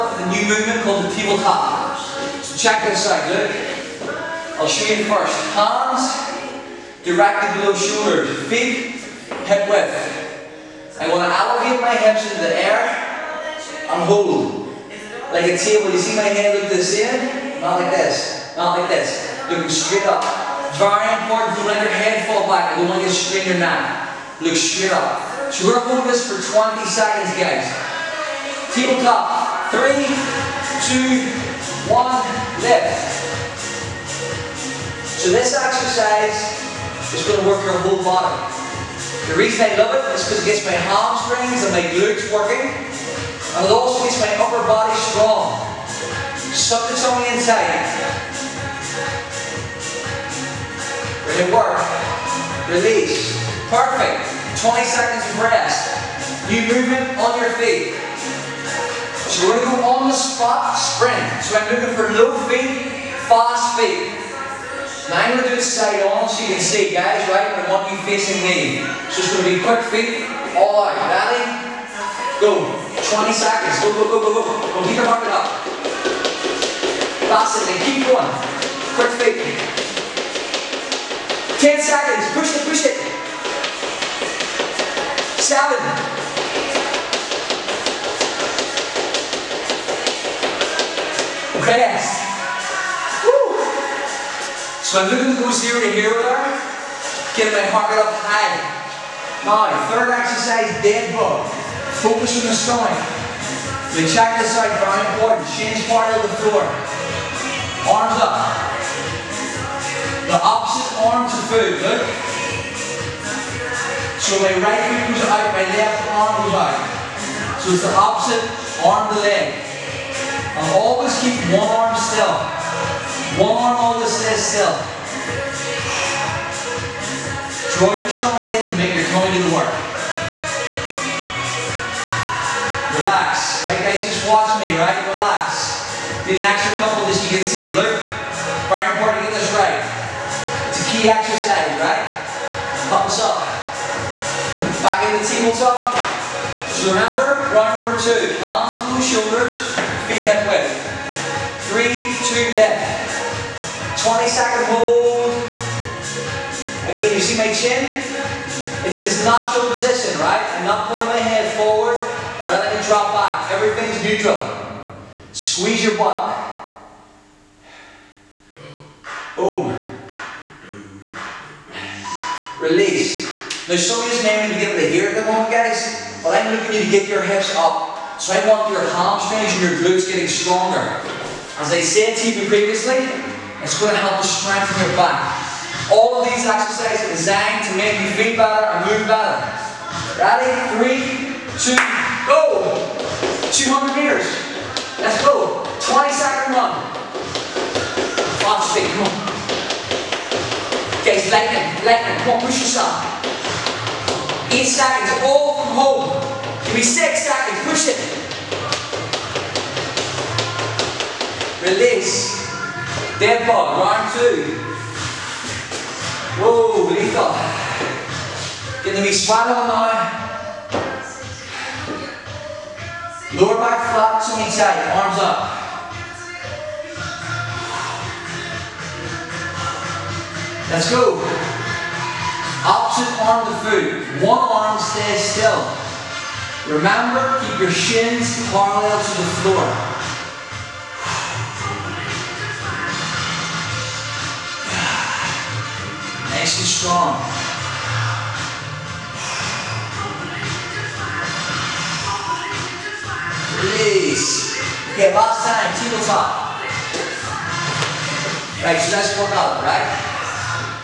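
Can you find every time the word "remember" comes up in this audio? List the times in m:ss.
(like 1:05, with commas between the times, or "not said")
2:26, 3:56.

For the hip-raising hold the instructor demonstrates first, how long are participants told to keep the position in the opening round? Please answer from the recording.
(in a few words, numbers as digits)
20 seconds.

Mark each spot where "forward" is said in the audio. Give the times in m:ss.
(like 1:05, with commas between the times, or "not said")
2:41.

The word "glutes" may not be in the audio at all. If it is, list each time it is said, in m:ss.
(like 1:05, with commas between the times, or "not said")
0:41, 2:59.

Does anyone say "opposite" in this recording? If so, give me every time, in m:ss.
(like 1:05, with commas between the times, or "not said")
1:50, 1:57, 3:52.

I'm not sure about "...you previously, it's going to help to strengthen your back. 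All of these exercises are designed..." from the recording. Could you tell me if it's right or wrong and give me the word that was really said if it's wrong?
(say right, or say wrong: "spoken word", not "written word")
right.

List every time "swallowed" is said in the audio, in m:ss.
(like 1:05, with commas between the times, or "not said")
3:39.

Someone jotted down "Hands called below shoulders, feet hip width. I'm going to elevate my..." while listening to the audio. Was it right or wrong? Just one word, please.
wrong.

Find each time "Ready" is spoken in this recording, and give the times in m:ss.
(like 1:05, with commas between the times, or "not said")
1:10, 3:10.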